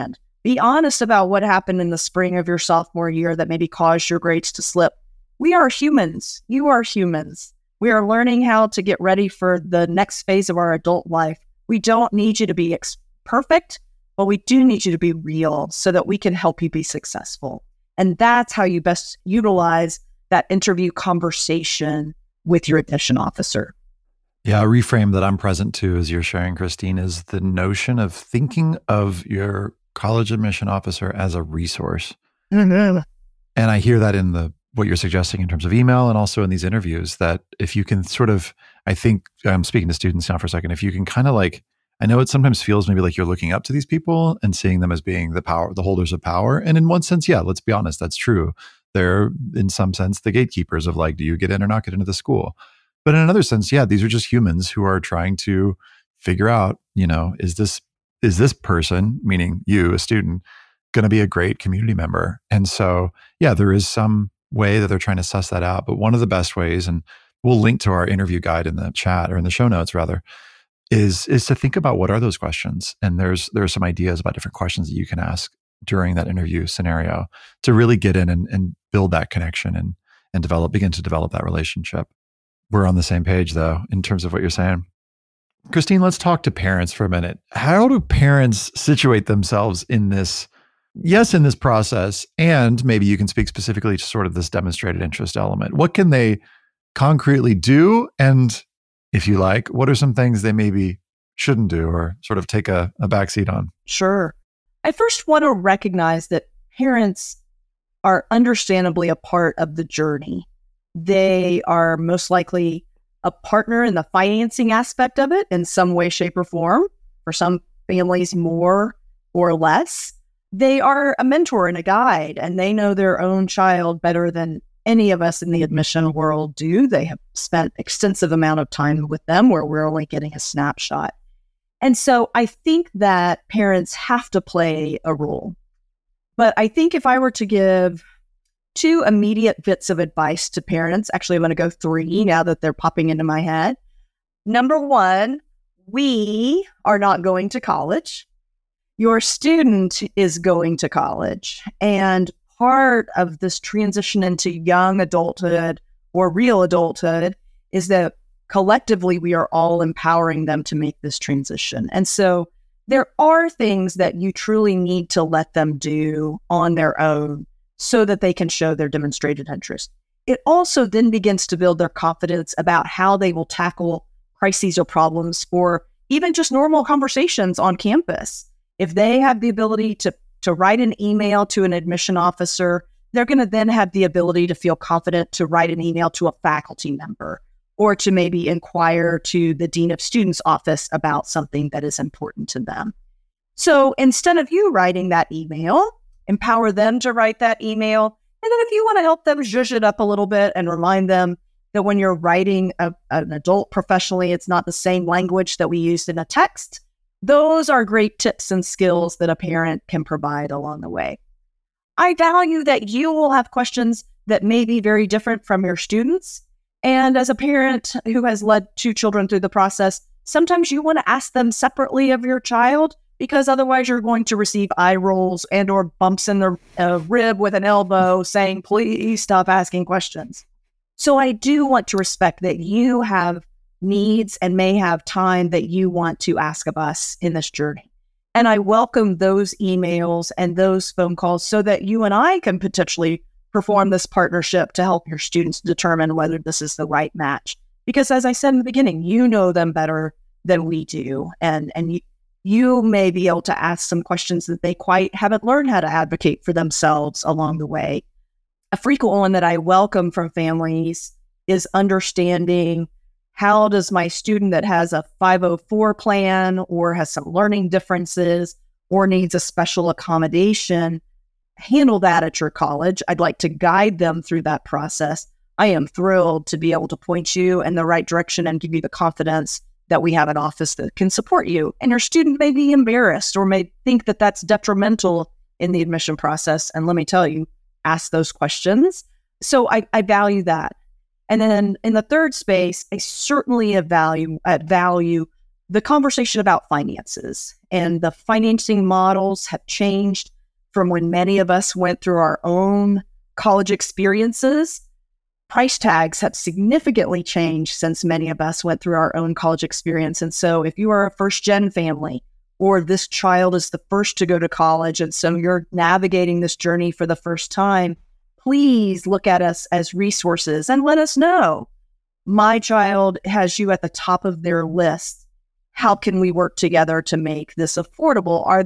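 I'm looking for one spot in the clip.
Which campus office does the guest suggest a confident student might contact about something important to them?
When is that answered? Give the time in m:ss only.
3:09.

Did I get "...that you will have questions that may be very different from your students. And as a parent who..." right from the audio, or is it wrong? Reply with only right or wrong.
right.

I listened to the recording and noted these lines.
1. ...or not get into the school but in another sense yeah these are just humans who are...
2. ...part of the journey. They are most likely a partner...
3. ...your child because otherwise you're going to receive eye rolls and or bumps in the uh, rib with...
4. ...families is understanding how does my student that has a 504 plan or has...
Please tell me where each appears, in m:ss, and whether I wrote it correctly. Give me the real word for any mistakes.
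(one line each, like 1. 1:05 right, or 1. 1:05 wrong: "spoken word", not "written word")
1. 0:51 right
2. 1:49 right
3. 3:42 right
4. 4:20 right.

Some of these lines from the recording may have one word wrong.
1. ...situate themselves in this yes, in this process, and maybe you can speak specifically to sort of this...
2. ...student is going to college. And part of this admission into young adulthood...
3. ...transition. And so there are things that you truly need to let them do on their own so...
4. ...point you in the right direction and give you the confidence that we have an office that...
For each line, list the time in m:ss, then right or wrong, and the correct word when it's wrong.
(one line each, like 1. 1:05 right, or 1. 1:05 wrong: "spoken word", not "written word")
1. 1:28 right
2. 2:29 wrong: "transition", not "admission"
3. 2:41 right
4. 4:36 right.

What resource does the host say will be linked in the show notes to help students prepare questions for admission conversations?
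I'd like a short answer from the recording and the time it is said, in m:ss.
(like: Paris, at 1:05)
interview guide, at 1:08.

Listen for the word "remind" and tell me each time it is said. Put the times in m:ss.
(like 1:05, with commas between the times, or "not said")
3:20.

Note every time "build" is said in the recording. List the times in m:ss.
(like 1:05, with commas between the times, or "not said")
1:18, 2:51.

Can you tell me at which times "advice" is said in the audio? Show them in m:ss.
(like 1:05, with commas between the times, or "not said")
2:19.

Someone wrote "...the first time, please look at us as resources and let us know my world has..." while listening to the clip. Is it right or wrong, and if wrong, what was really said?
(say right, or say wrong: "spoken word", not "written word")
wrong: "child", not "world".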